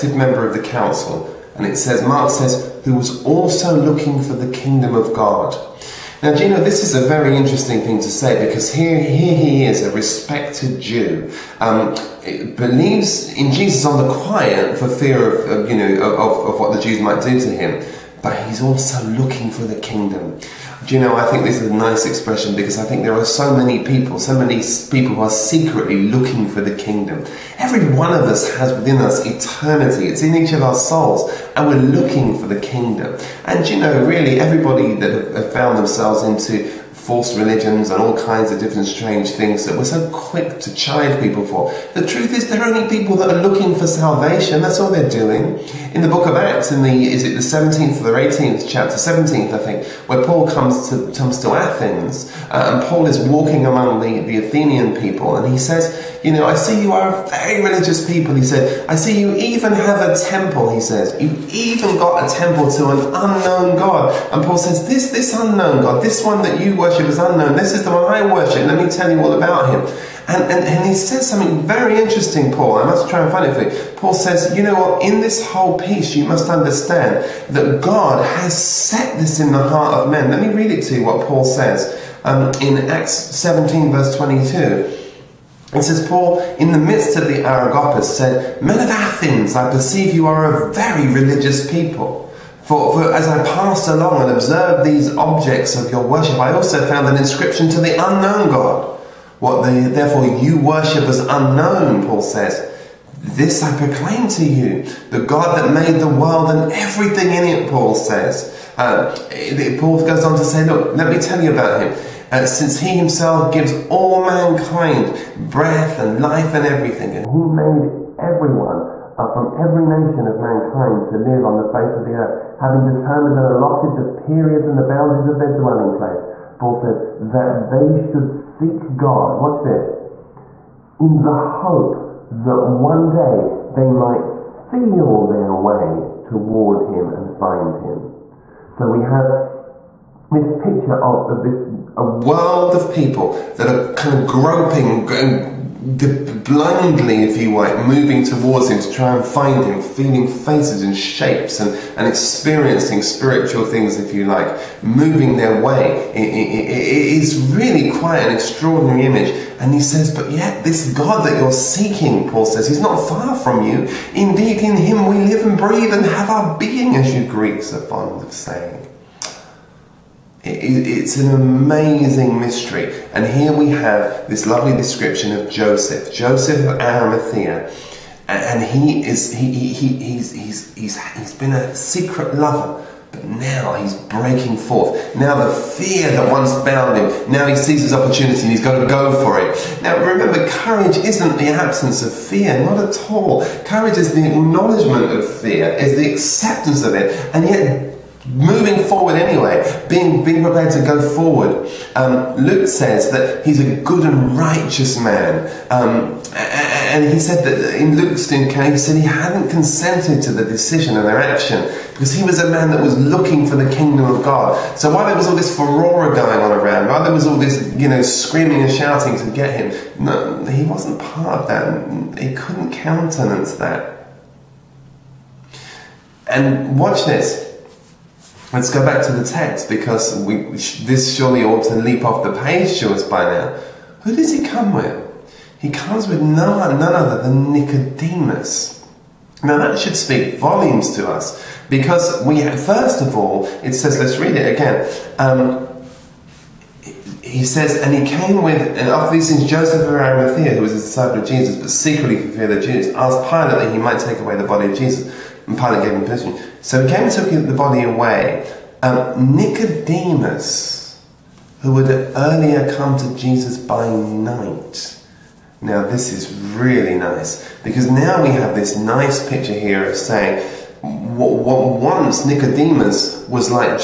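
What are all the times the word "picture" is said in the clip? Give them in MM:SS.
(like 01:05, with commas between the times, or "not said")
02:20, 04:29.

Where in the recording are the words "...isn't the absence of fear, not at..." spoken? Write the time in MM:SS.
03:10.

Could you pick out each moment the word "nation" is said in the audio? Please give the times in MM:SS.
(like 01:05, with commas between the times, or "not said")
01:59.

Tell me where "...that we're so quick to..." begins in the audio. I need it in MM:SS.
00:39.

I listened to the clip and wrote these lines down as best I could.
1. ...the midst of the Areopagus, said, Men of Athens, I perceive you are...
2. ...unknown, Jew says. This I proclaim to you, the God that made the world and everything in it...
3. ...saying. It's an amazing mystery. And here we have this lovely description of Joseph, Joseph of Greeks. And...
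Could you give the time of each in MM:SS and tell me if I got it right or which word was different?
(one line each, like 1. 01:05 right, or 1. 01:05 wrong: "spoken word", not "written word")
1. 01:26 right
2. 01:41 wrong: "Paul", not "Jew"
3. 02:48 wrong: "Arimathea", not "Greeks".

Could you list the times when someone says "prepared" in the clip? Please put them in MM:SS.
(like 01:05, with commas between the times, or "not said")
03:20.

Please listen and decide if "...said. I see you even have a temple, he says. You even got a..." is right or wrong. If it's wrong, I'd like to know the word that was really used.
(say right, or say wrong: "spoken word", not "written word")
right.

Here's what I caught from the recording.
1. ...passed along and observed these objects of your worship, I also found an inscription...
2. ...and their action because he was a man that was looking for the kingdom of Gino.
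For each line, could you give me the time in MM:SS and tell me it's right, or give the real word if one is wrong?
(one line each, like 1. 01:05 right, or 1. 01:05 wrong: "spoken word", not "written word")
1. 01:33 right
2. 03:30 wrong: "God", not "Gino".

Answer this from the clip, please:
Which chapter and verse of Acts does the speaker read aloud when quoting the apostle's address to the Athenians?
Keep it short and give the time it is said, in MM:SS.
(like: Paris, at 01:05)
Acts 17:22, at 01:22.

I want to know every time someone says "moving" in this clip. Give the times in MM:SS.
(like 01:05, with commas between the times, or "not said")
02:27, 02:34, 03:18.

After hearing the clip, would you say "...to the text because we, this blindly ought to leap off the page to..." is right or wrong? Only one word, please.
wrong.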